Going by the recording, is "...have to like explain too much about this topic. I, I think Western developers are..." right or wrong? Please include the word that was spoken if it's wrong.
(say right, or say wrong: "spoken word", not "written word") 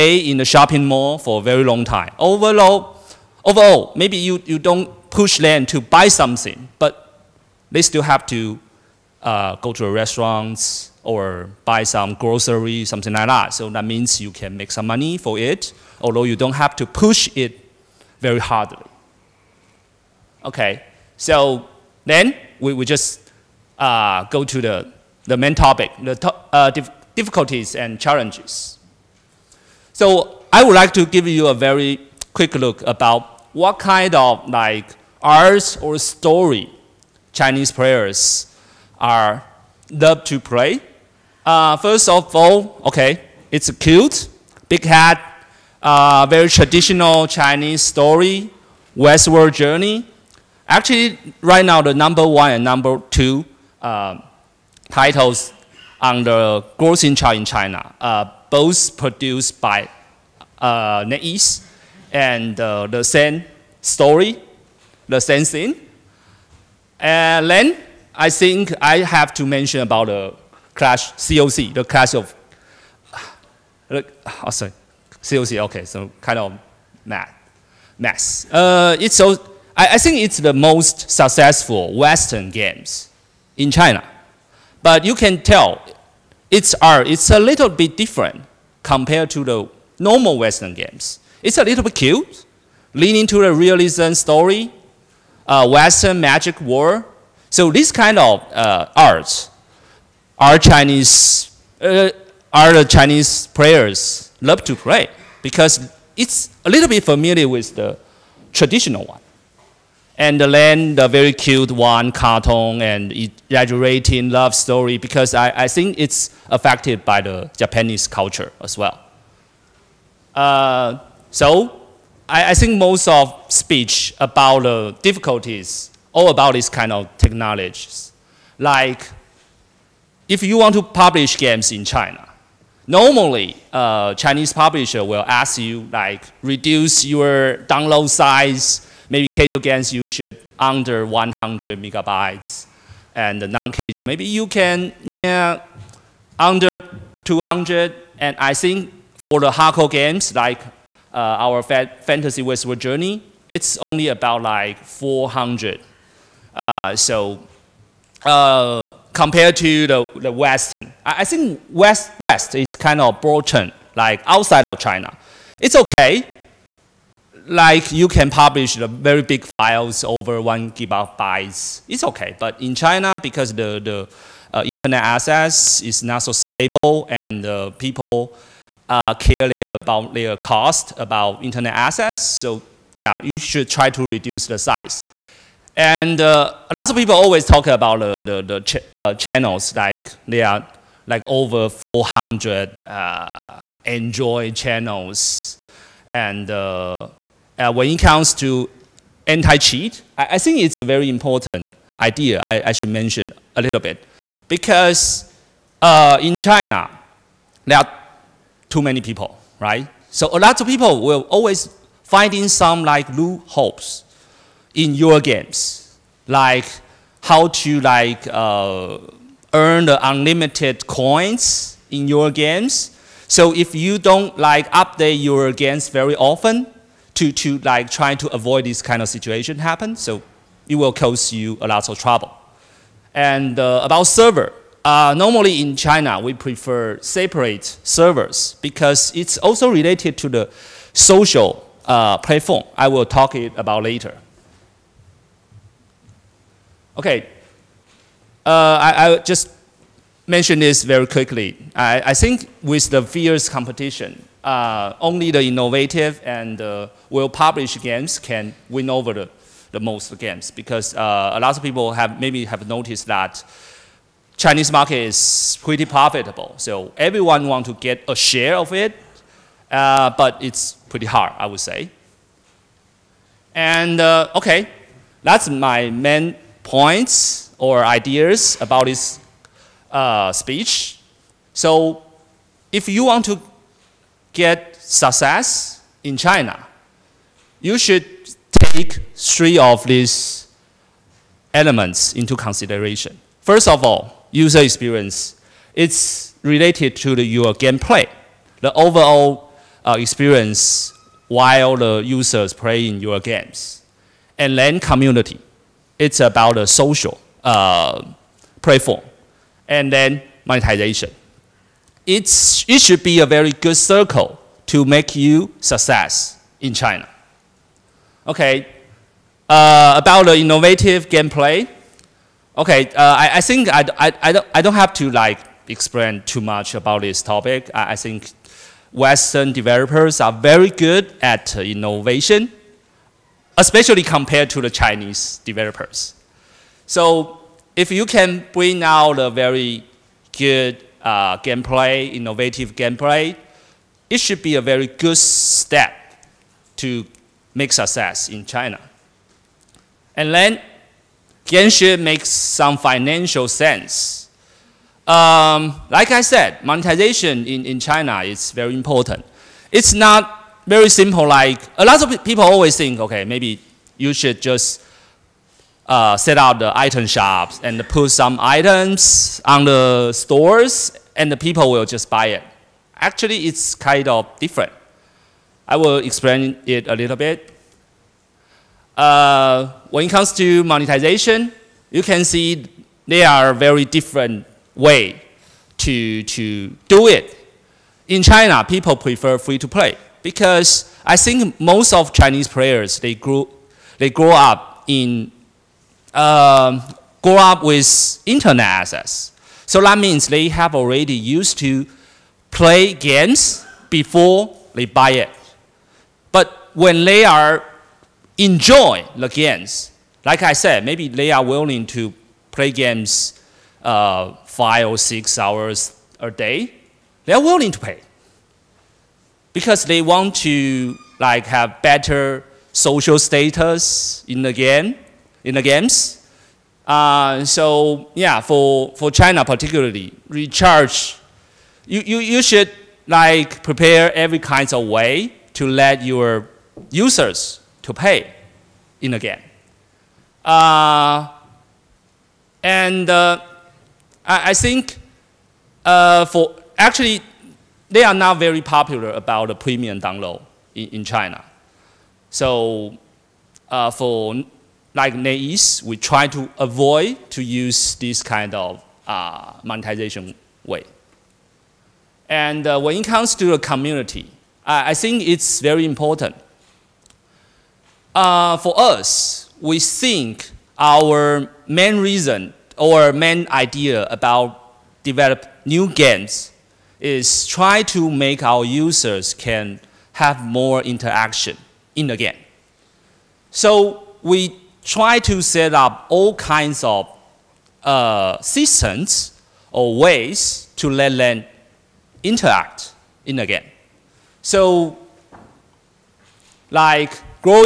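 right.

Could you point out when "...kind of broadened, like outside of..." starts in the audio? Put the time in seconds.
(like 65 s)
162 s.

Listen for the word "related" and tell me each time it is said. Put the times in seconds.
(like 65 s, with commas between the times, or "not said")
239 s, 296 s.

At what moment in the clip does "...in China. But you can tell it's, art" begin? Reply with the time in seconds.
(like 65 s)
83 s.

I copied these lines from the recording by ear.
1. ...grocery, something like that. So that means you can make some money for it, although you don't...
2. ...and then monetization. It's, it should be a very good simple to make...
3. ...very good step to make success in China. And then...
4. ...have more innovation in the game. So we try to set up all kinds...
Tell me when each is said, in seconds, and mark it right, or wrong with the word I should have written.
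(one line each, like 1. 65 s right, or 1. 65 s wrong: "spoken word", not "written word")
1. 12 s right
2. 309 s wrong: "circle", not "simple"
3. 344 s right
4. 480 s wrong: "interaction", not "innovation".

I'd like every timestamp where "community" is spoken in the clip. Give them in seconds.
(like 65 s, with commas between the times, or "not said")
304 s, 463 s.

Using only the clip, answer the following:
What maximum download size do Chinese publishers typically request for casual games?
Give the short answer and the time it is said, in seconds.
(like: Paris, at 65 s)
100 megabytes, at 141 s.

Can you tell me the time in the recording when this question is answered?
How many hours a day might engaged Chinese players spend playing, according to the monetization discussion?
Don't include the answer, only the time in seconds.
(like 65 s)
414 s.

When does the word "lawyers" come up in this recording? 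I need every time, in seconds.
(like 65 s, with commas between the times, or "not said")
not said.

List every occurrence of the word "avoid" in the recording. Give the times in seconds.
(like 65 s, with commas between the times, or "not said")
228 s, 456 s.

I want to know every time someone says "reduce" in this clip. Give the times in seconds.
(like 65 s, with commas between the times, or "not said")
136 s, 184 s.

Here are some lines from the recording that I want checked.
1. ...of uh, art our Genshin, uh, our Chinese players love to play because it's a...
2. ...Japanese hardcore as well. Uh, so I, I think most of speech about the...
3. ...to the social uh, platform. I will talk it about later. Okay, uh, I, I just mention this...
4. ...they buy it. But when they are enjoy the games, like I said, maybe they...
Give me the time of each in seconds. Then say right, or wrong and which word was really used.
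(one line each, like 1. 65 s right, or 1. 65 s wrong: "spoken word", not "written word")
1. 98 s wrong: "Chinese", not "Genshin"
2. 117 s wrong: "culture", not "hardcore"
3. 240 s right
4. 404 s right.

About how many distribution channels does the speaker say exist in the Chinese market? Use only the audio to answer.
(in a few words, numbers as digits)
over 400.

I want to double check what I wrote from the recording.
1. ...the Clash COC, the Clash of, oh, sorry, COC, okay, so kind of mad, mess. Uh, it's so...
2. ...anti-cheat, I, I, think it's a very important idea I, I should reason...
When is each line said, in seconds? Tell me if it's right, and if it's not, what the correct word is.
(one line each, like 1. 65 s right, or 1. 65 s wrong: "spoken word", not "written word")
1. 70 s right
2. 199 s wrong: "mention", not "reason".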